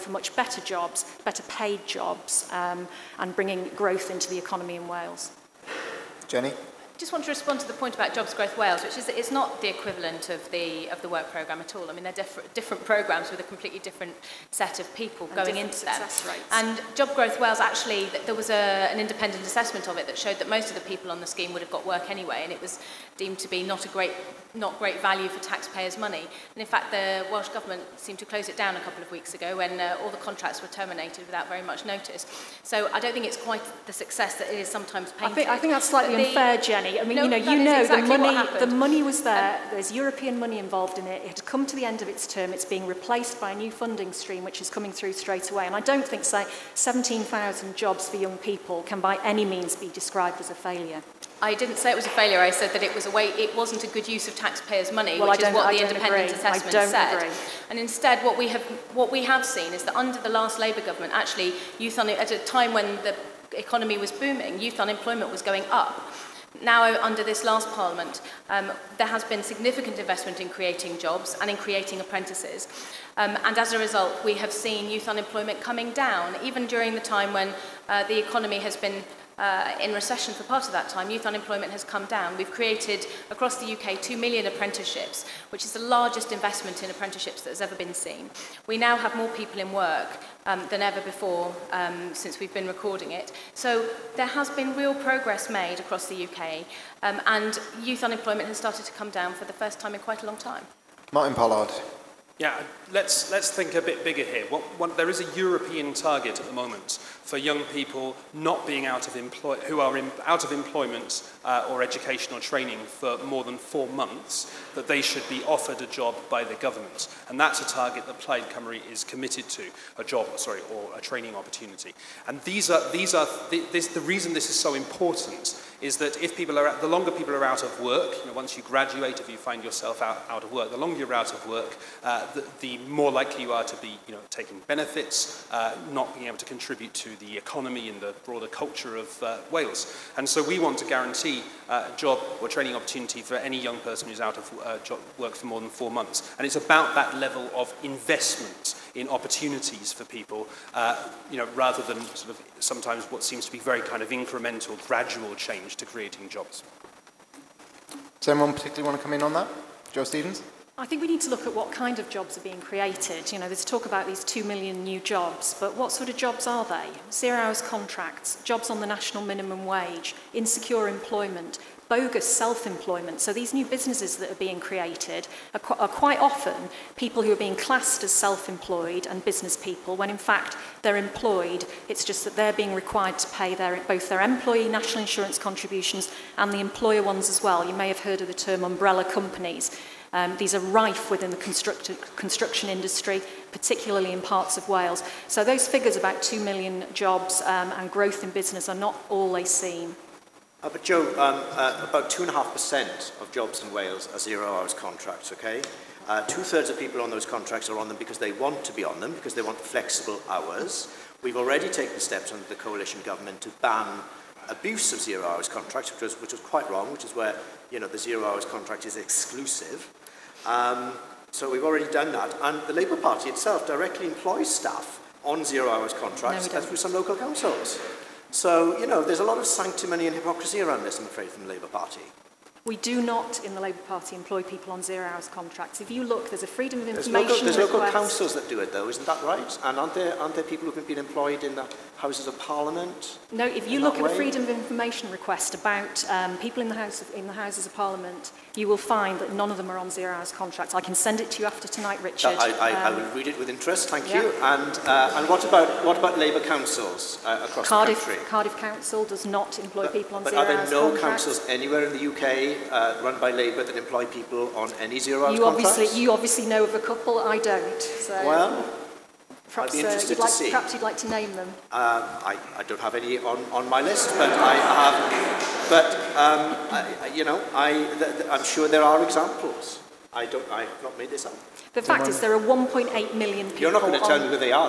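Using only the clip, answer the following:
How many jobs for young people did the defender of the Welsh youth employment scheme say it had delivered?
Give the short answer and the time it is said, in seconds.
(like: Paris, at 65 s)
17,000, at 46 s.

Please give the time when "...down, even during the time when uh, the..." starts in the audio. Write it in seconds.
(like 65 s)
75 s.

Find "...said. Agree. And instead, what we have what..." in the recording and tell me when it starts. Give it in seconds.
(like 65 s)
56 s.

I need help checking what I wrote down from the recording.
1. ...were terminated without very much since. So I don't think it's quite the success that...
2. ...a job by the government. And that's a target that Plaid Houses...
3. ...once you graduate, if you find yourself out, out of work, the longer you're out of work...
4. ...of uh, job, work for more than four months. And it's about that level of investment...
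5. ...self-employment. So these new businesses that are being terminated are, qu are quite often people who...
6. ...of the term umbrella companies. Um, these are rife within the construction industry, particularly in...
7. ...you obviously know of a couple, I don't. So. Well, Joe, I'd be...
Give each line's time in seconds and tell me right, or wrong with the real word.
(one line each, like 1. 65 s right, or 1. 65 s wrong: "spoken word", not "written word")
1. 30 s wrong: "notice", not "since"
2. 115 s wrong: "Cymru", not "Houses"
3. 128 s right
4. 144 s right
5. 172 s wrong: "created", not "terminated"
6. 188 s right
7. 265 s wrong: "Perhaps", not "Joe".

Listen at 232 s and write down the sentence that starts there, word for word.
We do not, in the Labour Party, employ people on zero hours contracts.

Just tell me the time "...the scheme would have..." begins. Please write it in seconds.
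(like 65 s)
21 s.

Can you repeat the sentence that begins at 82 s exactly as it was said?
We've created across the UK 2 million apprenticeships, which is the largest investment in apprenticeships that has ever been seen.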